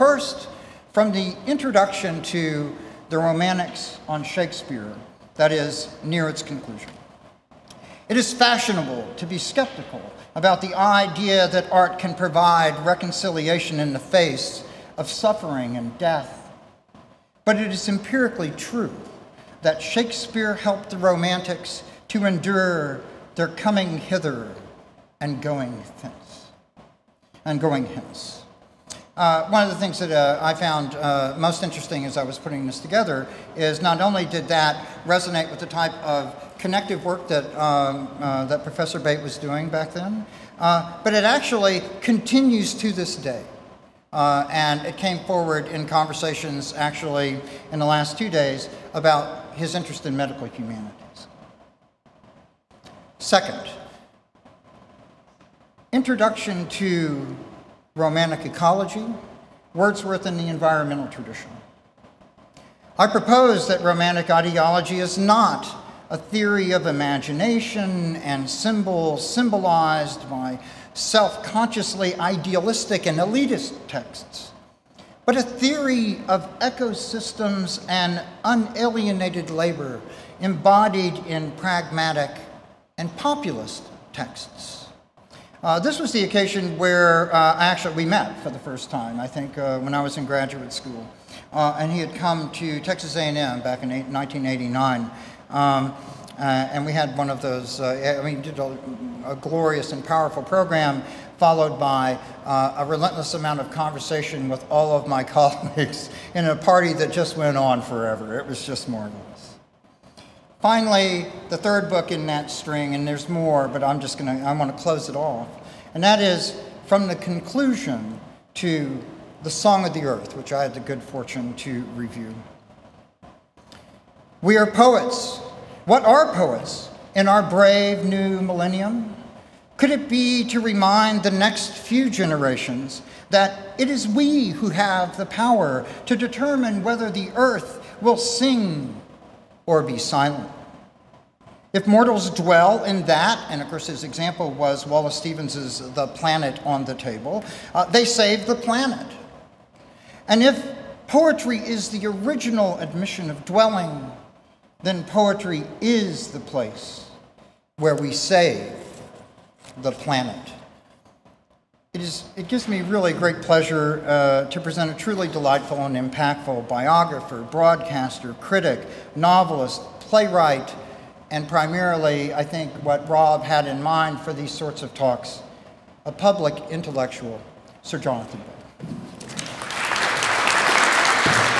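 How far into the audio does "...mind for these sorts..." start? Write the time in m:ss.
2:53.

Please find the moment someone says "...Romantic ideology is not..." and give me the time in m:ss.
1:03.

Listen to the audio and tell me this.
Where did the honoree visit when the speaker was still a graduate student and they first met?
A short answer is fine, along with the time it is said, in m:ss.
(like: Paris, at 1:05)
Texas A&M, at 1:32.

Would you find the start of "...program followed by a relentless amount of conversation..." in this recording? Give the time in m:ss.
1:40.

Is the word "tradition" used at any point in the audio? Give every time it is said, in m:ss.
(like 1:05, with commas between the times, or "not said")
1:01.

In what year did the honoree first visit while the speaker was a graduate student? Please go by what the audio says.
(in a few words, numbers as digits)
1989.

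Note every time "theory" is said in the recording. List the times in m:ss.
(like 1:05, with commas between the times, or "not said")
1:06, 1:15.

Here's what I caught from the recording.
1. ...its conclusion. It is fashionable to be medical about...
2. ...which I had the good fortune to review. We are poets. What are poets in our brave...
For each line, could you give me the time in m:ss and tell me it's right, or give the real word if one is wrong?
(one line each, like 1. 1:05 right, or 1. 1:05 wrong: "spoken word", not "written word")
1. 0:06 wrong: "skeptical", not "medical"
2. 2:00 right.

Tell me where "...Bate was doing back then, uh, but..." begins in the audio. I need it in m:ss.
0:38.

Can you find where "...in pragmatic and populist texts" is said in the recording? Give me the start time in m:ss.
1:21.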